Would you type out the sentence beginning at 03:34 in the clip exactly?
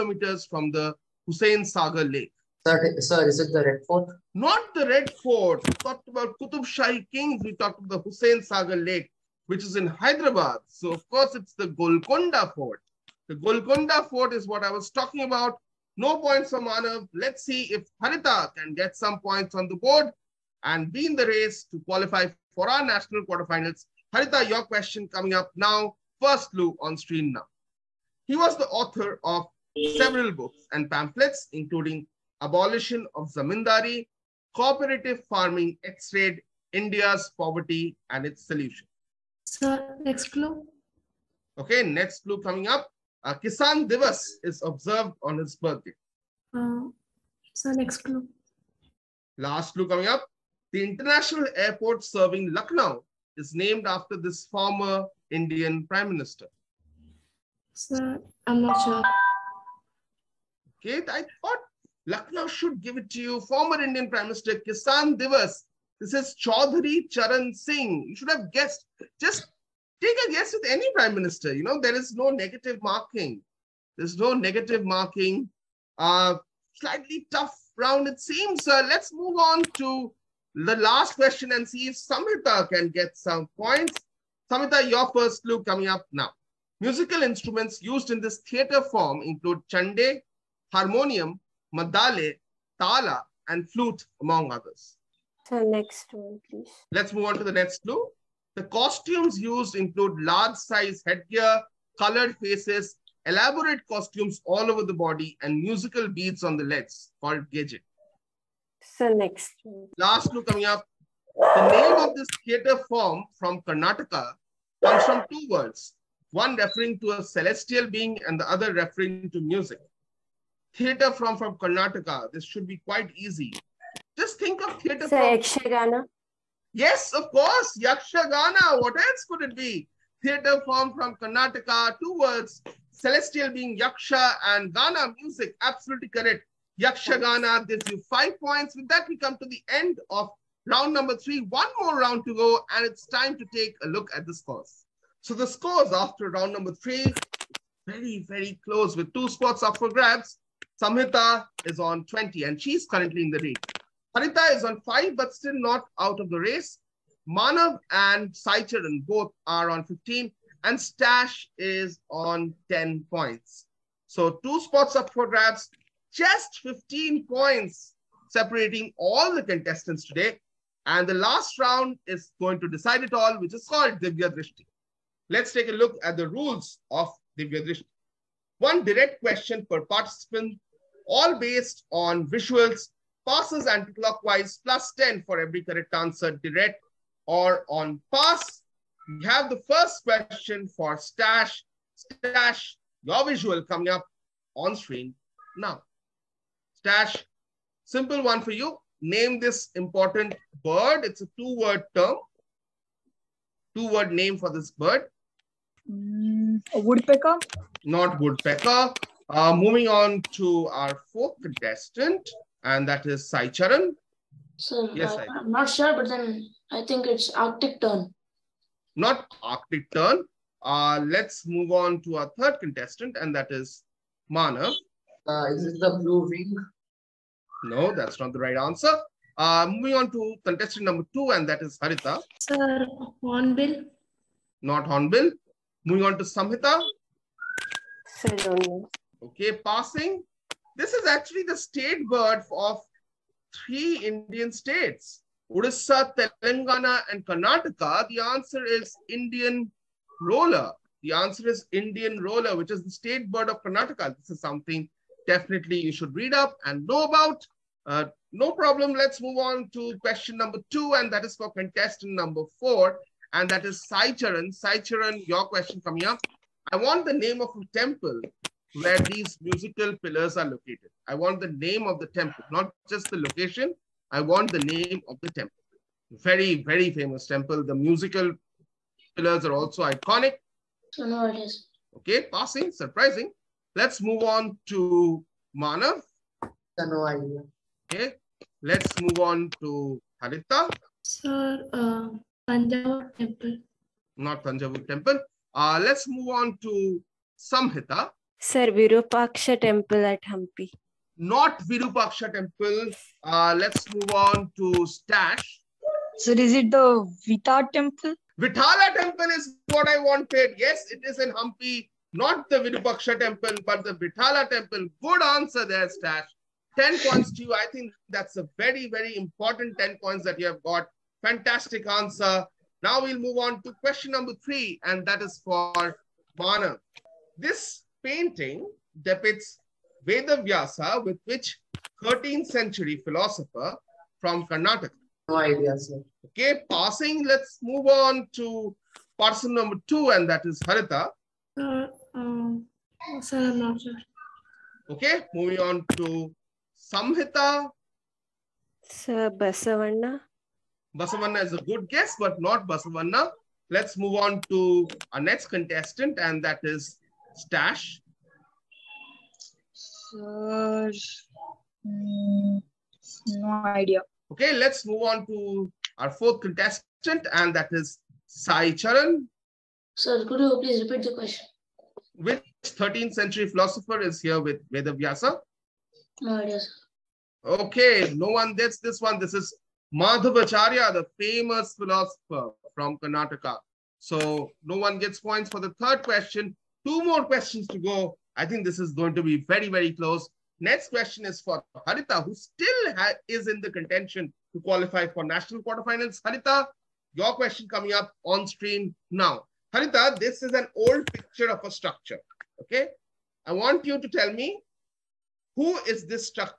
Sir, yes, uh, I, am not sure, but then I think it's Arctic Tern.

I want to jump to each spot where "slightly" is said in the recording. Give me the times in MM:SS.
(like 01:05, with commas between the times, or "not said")
01:16.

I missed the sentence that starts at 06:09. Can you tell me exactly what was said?
Sir, could you please repeat the question?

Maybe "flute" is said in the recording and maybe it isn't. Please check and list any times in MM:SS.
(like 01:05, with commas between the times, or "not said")
01:33.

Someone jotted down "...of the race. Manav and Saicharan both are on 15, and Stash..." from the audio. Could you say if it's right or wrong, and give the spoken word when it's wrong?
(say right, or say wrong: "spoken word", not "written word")
right.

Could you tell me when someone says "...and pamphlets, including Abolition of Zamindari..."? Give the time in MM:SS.
00:30.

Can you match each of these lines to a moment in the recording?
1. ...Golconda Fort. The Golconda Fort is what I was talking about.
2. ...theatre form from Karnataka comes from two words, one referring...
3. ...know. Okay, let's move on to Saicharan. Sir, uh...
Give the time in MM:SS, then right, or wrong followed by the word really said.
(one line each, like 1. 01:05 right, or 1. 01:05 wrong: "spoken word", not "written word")
1. 00:11 right
2. 01:52 right
3. 04:46 wrong: "Harita", not "Saicharan".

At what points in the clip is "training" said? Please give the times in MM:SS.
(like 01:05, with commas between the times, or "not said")
not said.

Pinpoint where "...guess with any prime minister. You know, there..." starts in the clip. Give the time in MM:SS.
01:10.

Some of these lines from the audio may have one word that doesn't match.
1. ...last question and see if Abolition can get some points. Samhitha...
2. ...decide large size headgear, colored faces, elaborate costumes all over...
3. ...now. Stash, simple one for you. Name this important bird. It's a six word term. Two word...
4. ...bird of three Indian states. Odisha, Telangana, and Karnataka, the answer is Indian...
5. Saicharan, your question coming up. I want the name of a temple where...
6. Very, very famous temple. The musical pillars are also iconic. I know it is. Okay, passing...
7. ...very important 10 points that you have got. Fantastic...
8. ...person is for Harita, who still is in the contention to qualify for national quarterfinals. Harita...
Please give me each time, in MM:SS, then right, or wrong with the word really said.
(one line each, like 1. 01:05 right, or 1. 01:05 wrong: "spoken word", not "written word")
1. 01:20 wrong: "Samhitha", not "Abolition"
2. 01:39 wrong: "include", not "decide"
3. 03:15 wrong: "two", not "six"
4. 04:02 right
5. 04:24 right
6. 04:36 right
7. 05:18 right
8. 06:30 wrong: "question", not "person".